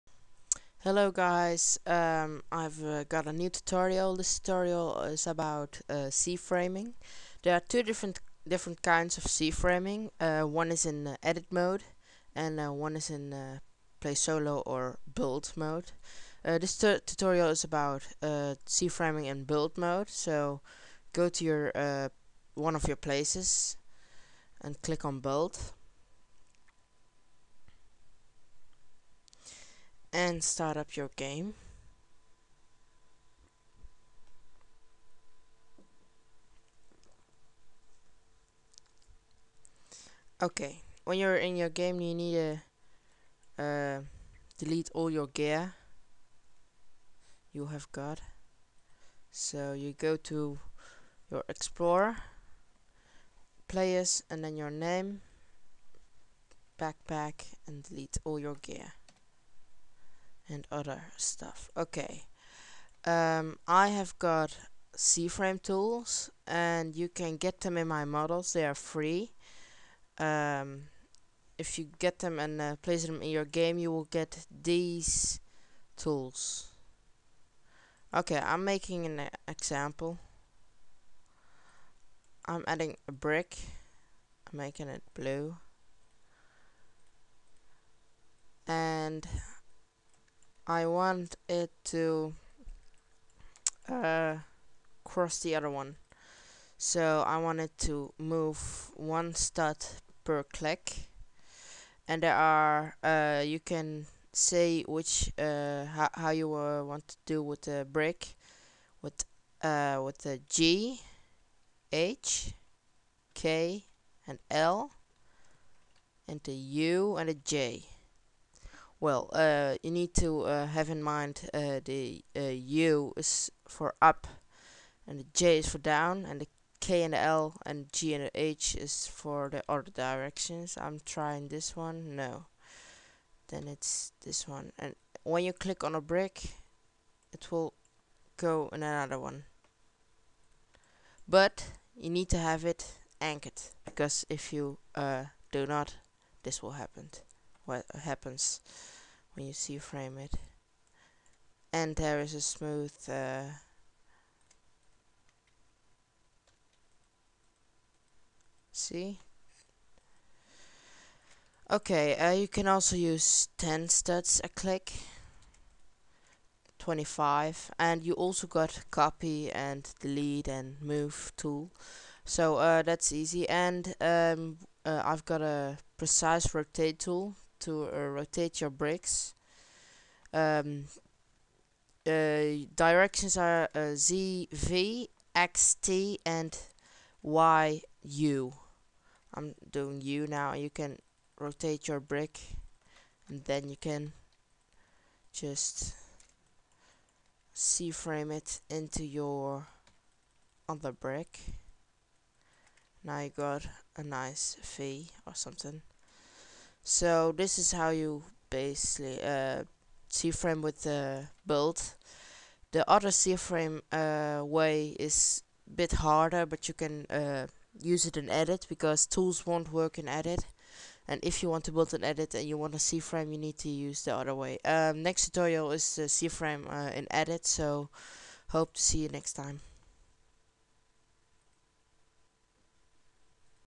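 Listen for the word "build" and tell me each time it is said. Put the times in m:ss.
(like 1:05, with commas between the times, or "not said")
0:15, 0:19, 0:25, 3:31, 3:41.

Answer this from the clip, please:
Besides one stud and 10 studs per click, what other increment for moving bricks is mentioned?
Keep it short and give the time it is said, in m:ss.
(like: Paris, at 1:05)
25, at 2:46.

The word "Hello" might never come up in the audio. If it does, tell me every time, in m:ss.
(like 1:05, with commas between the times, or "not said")
0:00.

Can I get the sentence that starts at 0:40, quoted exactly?
Okay, when you're in your game you need to uh, delete all your gear you have got.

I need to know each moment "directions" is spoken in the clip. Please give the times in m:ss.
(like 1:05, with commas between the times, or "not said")
2:09, 3:02.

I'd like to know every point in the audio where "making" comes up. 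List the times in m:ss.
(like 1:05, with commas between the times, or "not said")
1:18, 1:24.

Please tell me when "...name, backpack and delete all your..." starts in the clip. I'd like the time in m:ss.
0:54.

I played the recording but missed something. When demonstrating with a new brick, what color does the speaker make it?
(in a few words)
Blue.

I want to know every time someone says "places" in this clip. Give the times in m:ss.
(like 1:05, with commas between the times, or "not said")
0:22, 1:12.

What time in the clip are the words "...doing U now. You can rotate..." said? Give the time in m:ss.
3:09.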